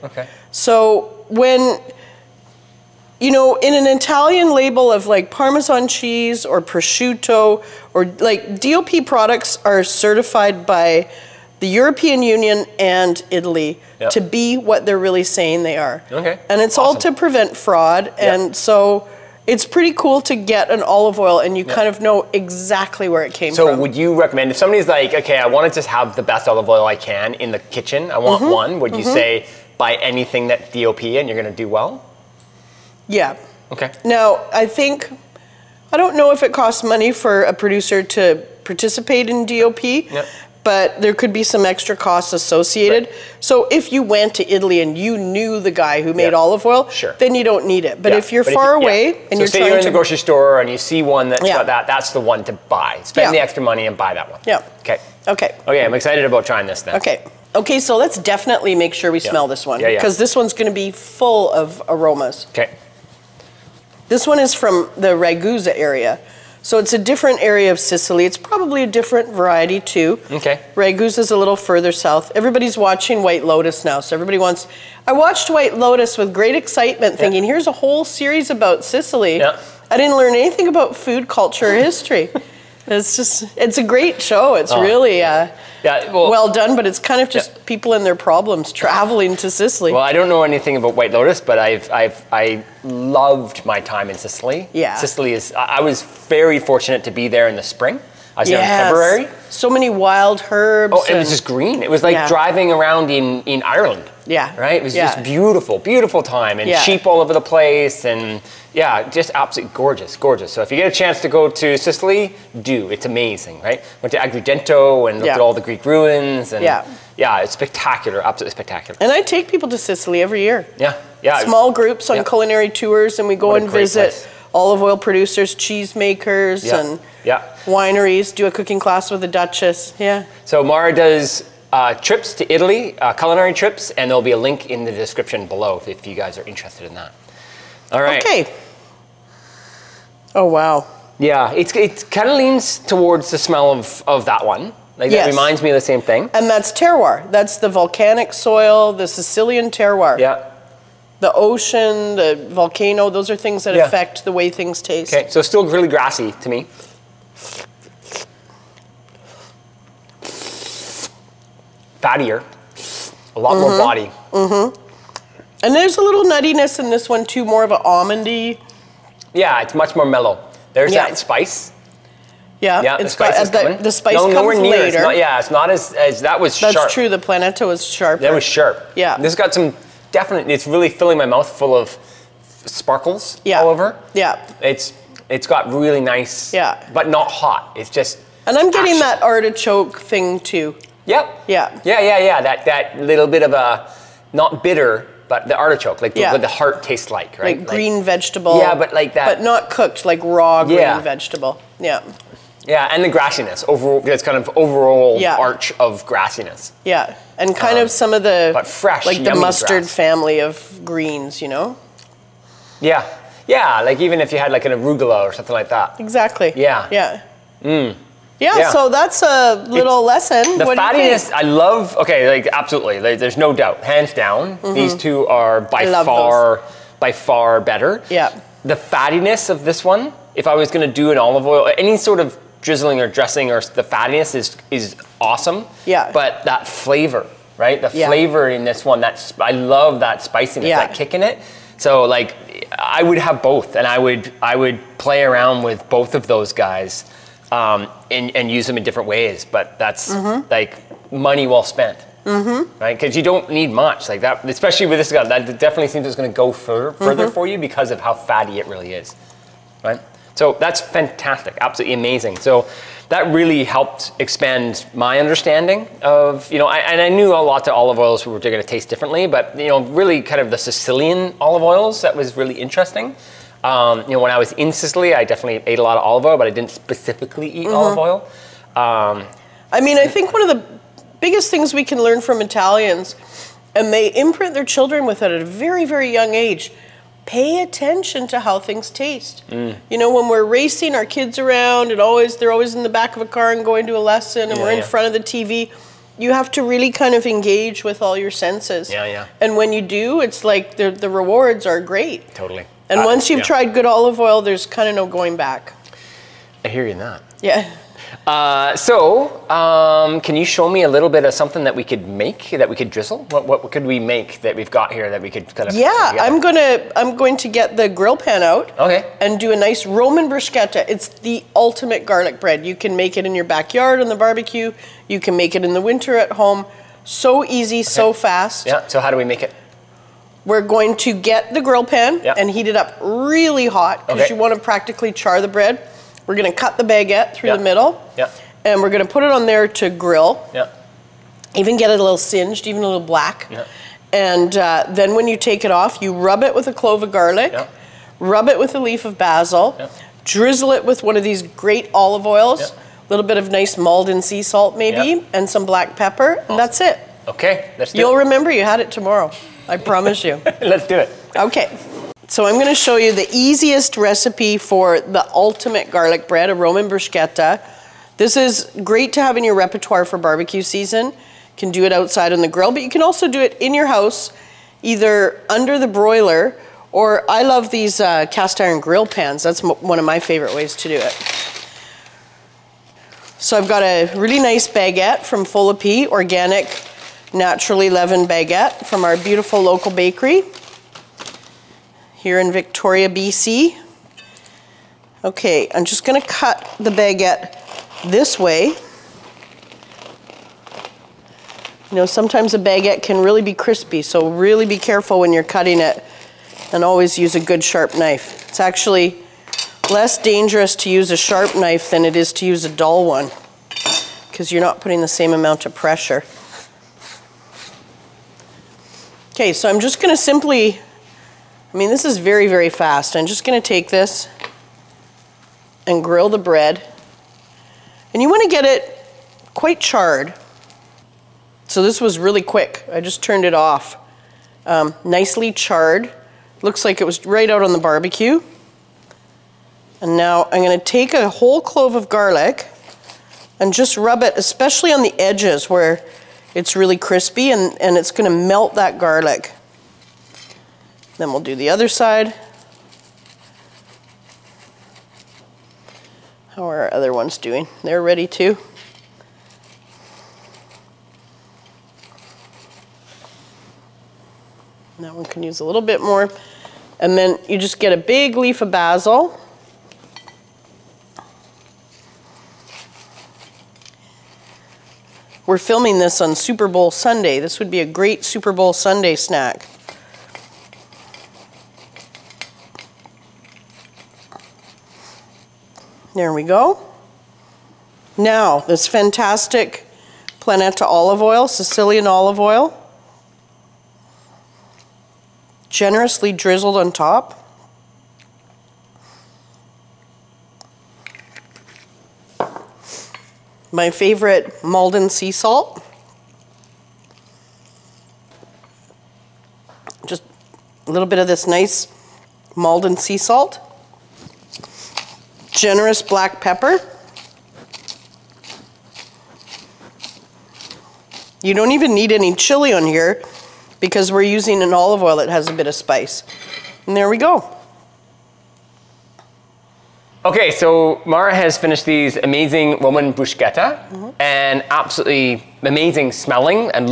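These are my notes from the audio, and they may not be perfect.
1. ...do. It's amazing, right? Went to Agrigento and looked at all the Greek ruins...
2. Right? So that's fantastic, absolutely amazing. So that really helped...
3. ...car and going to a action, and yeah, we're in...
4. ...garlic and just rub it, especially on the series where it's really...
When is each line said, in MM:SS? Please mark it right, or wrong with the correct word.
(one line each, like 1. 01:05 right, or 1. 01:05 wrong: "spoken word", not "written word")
1. 01:52 right
2. 04:19 right
3. 04:53 wrong: "lesson", not "action"
4. 07:22 wrong: "edges", not "series".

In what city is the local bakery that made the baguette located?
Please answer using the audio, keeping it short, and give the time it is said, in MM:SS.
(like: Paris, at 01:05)
Victoria, BC, at 06:32.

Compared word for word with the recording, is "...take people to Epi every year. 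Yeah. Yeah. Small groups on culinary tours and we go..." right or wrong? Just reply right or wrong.
wrong.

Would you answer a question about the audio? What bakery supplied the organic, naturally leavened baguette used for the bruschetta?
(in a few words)
Fol Epi.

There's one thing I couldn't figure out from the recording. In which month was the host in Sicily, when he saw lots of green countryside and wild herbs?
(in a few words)
February.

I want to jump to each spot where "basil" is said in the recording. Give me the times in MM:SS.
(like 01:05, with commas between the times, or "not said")
05:49, 07:48.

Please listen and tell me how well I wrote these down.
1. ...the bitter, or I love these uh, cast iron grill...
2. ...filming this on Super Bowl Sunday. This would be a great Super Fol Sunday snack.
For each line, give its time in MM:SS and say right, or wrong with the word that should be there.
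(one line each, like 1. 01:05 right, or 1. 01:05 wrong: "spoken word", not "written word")
1. 06:15 wrong: "broiler", not "bitter"
2. 07:55 wrong: "Bowl", not "Fol".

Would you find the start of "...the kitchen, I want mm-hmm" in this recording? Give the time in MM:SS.
00:27.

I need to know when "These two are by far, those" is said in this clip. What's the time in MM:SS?
03:44.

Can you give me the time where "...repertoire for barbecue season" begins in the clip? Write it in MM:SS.
06:09.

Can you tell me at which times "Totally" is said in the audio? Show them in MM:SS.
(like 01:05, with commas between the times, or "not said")
05:02.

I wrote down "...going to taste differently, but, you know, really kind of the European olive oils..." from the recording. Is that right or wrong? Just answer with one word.
wrong.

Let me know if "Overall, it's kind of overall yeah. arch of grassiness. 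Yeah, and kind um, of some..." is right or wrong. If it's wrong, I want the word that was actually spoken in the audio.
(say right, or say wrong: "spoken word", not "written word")
right.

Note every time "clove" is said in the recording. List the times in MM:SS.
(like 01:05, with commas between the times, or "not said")
05:46, 07:21.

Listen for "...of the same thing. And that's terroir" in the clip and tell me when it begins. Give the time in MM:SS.
02:25.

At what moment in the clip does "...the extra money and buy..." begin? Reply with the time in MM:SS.
00:53.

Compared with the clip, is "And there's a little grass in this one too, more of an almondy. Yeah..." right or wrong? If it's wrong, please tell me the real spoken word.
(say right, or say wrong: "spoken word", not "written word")
wrong: "nuttiness", not "grass".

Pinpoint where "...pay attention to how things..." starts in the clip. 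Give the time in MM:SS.
04:47.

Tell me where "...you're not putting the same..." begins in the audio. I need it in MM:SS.
06:54.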